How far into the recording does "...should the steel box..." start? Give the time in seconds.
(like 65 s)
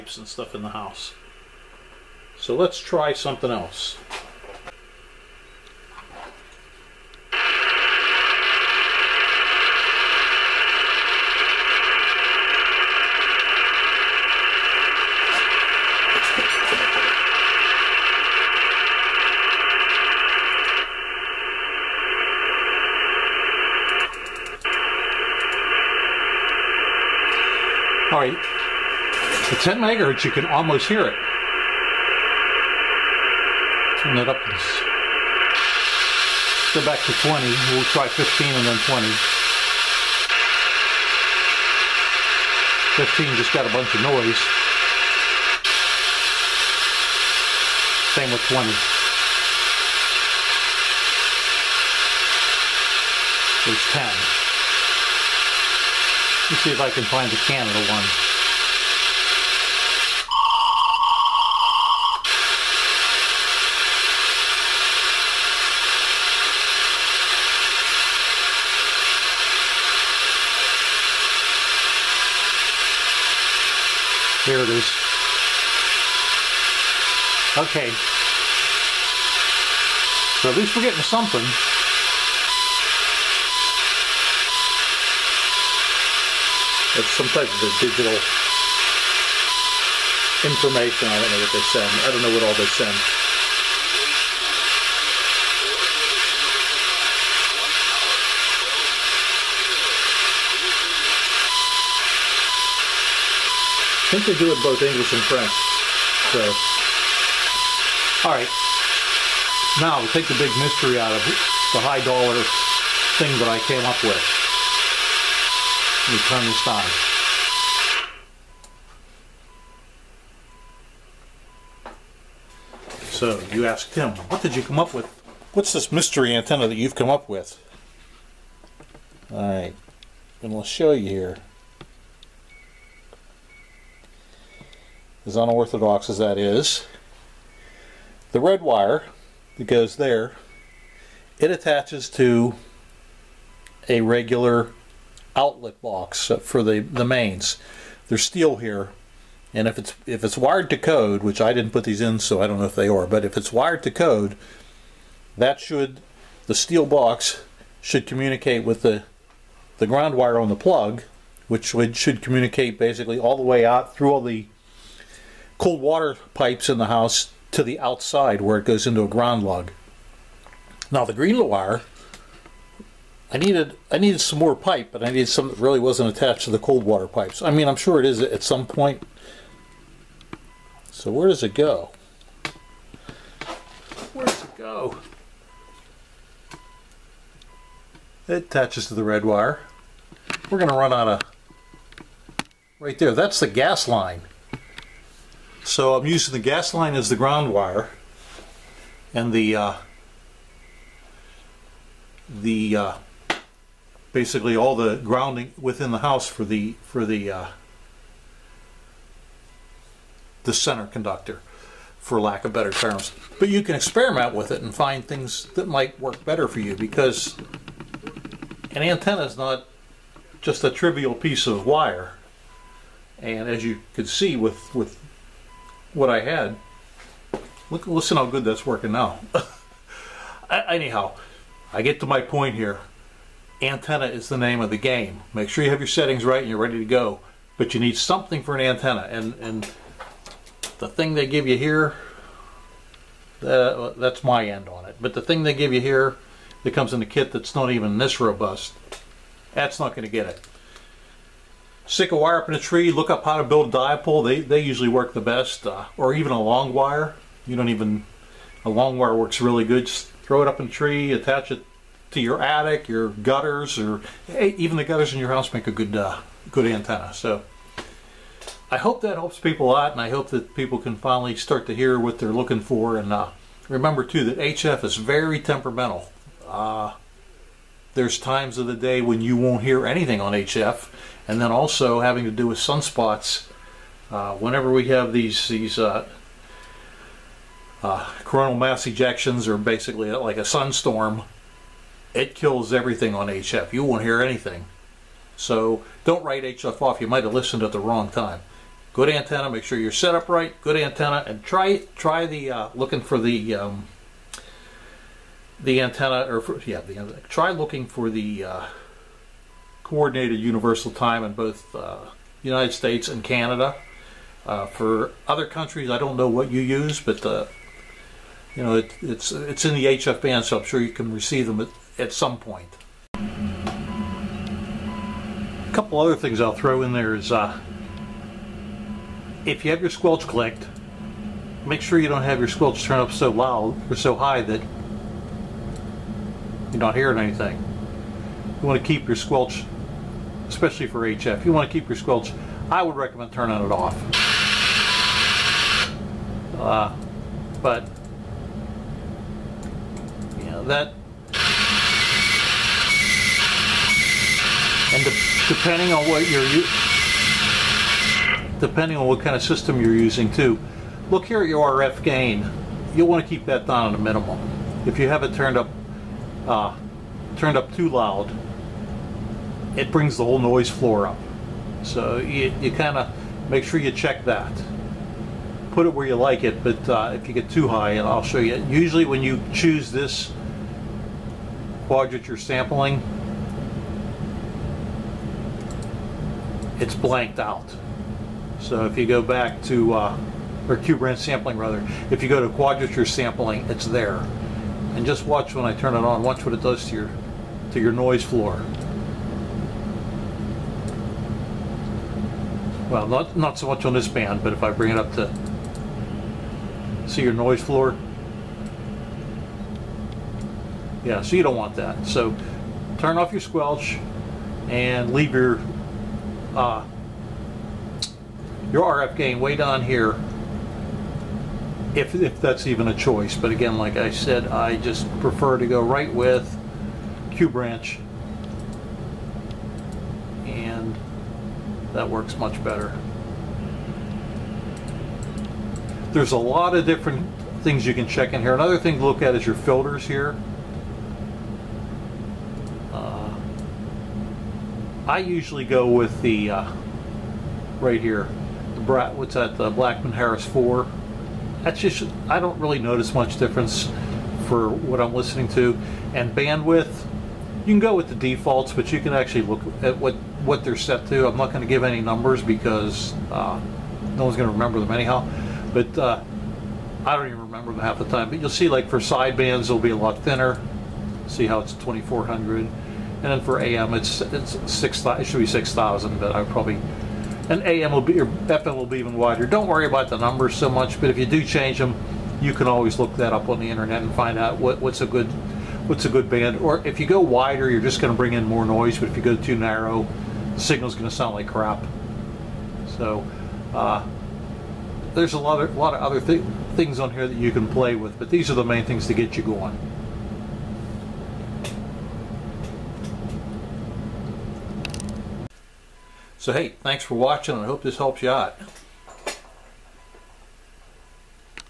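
155 s.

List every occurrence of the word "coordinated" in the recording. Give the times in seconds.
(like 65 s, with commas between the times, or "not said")
309 s.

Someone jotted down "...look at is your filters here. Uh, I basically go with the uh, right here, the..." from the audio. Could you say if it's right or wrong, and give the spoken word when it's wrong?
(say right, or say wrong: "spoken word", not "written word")
wrong: "usually", not "basically".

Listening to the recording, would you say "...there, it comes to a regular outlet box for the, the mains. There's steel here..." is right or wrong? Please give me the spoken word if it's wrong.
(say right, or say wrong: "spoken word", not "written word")
wrong: "attaches", not "comes".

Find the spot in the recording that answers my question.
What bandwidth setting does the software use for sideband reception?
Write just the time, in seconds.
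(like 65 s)
471 s.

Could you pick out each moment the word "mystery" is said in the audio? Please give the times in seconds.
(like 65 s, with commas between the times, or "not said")
110 s, 125 s.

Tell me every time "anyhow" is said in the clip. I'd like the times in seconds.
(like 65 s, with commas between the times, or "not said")
230 s, 464 s.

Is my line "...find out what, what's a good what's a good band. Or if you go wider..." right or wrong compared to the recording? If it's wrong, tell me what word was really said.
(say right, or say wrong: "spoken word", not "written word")
right.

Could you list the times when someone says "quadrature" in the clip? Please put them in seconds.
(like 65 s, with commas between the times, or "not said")
381 s, 392 s.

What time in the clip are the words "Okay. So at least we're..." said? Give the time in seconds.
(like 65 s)
77 s.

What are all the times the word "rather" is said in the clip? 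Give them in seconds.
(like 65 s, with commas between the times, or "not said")
391 s.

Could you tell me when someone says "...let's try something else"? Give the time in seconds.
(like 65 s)
2 s.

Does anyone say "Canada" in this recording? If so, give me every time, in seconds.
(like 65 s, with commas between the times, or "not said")
57 s, 313 s.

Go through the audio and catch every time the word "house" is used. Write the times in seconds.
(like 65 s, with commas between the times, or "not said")
0 s, 166 s, 205 s, 265 s.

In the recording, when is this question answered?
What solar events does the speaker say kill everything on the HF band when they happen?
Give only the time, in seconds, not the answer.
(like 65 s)
288 s.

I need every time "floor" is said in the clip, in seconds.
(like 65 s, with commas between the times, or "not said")
370 s, 398 s, 407 s.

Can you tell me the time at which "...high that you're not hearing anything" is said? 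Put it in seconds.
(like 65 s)
334 s.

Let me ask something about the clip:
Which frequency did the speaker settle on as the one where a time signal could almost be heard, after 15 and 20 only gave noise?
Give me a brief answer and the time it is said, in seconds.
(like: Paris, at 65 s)
10 megahertz, at 29 s.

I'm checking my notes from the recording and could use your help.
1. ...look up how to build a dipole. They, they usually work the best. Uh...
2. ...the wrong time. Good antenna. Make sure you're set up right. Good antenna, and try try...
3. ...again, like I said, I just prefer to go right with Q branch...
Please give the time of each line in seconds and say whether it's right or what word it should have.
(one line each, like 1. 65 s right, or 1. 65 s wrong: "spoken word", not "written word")
1. 252 s right
2. 297 s right
3. 423 s right.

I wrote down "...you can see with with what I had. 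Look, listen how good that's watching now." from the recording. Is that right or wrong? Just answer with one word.
wrong.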